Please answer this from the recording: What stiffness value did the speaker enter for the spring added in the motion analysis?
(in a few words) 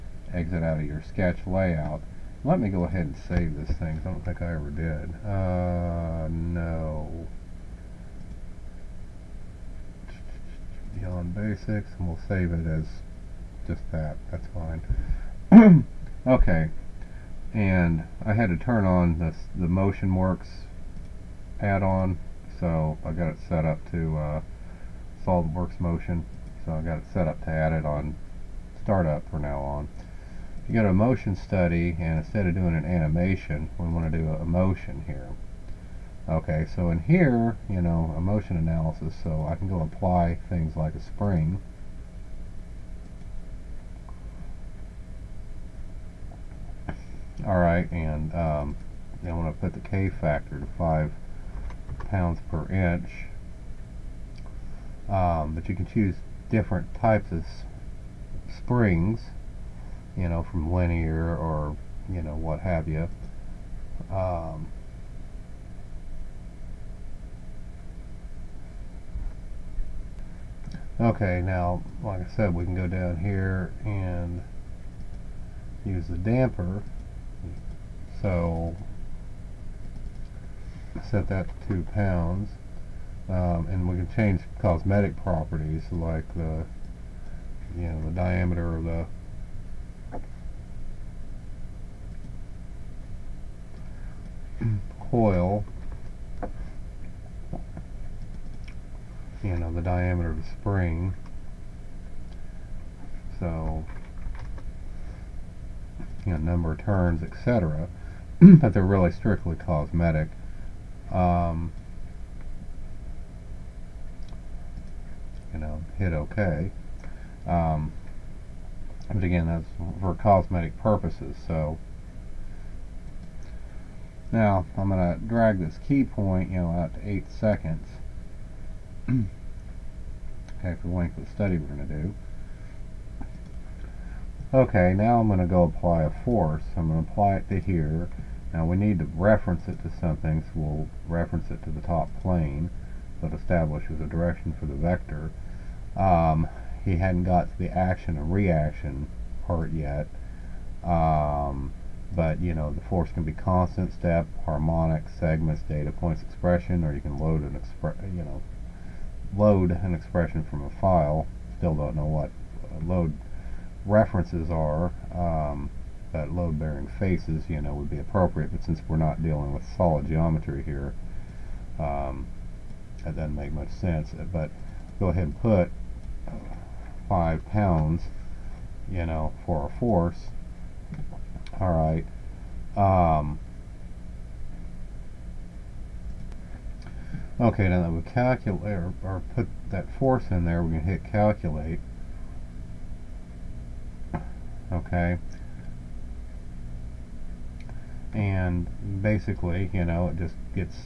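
5 pounds per inch.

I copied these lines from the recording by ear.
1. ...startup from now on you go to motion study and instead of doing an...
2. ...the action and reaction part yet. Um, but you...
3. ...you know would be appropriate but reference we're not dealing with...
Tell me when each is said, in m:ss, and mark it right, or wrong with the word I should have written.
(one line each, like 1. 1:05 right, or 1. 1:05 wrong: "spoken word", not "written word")
1. 0:28 right
2. 2:27 right
3. 2:47 wrong: "since", not "reference".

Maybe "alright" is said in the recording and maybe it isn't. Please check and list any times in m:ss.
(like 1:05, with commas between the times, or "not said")
0:47.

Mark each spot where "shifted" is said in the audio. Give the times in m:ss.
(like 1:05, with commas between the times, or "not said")
not said.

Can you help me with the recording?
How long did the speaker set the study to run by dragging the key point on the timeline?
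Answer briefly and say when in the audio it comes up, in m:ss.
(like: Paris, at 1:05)
8 seconds, at 2:07.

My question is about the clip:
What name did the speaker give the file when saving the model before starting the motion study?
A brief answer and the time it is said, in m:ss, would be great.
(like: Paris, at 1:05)
Beyond Basics, at 0:10.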